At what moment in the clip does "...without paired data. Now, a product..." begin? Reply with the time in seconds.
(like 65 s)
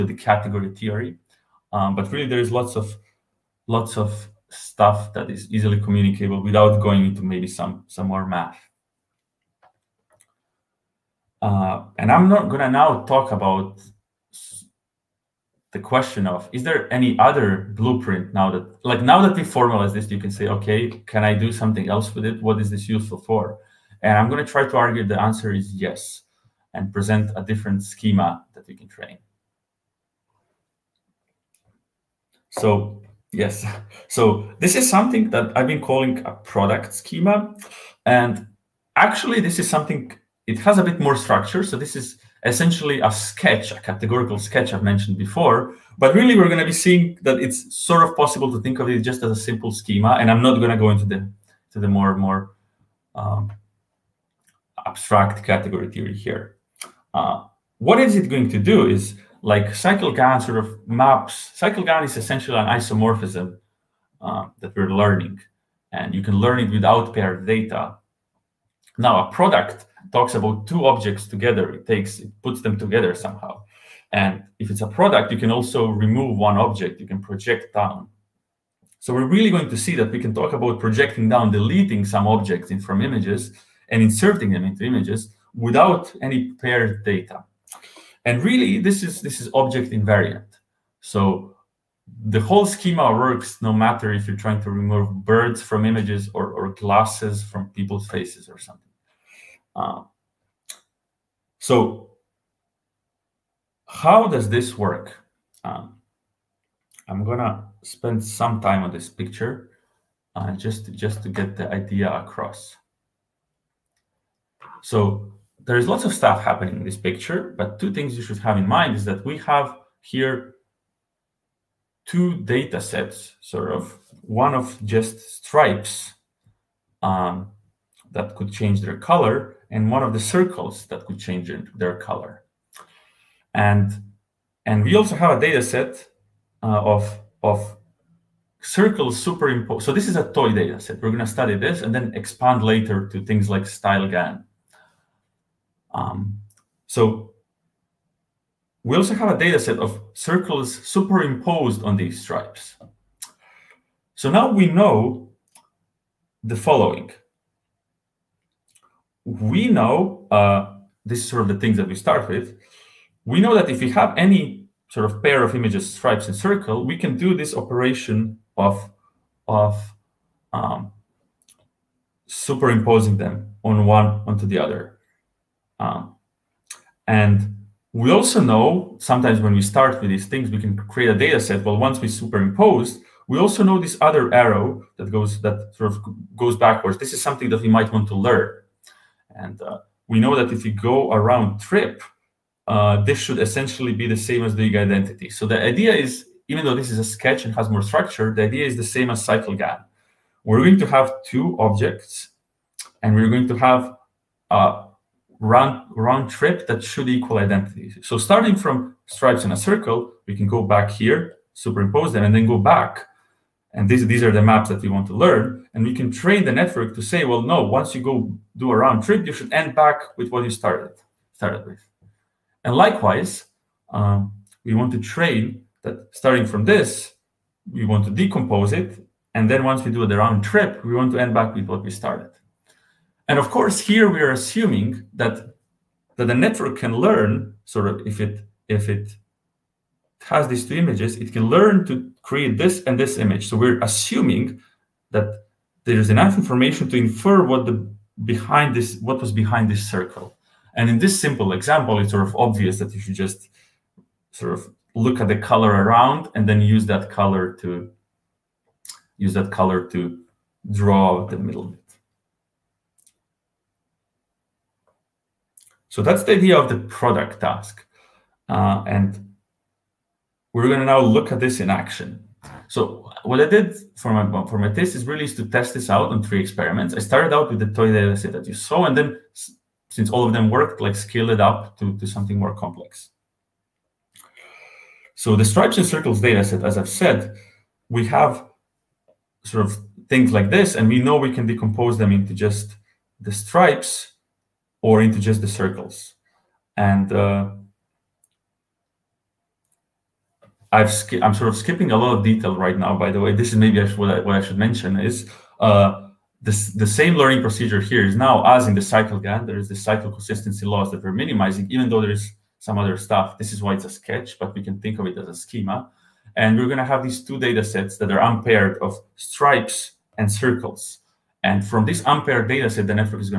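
66 s.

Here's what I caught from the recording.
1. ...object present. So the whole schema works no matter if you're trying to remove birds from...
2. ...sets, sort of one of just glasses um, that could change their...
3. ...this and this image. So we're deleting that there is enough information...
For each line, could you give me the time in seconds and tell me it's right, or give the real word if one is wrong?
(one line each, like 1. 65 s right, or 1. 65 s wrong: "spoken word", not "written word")
1. 89 s wrong: "invariant", not "present"
2. 122 s wrong: "stripes", not "glasses"
3. 242 s wrong: "assuming", not "deleting".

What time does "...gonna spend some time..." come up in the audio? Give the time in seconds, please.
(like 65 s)
107 s.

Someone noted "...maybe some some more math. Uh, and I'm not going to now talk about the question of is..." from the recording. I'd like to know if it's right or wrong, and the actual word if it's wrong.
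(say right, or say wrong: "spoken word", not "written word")
right.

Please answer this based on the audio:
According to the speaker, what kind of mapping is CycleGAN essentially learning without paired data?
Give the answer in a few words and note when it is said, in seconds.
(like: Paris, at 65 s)
An isomorphism, at 62 s.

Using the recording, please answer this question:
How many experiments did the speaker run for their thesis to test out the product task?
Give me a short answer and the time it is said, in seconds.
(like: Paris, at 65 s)
3, at 276 s.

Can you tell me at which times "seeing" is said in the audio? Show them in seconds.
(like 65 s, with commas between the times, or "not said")
46 s.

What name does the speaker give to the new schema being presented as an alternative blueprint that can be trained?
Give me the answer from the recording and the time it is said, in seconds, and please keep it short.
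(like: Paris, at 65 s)
product schema, at 36 s.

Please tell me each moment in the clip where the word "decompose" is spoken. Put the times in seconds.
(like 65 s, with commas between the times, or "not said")
228 s, 291 s.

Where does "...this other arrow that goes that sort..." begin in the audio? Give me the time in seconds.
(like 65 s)
183 s.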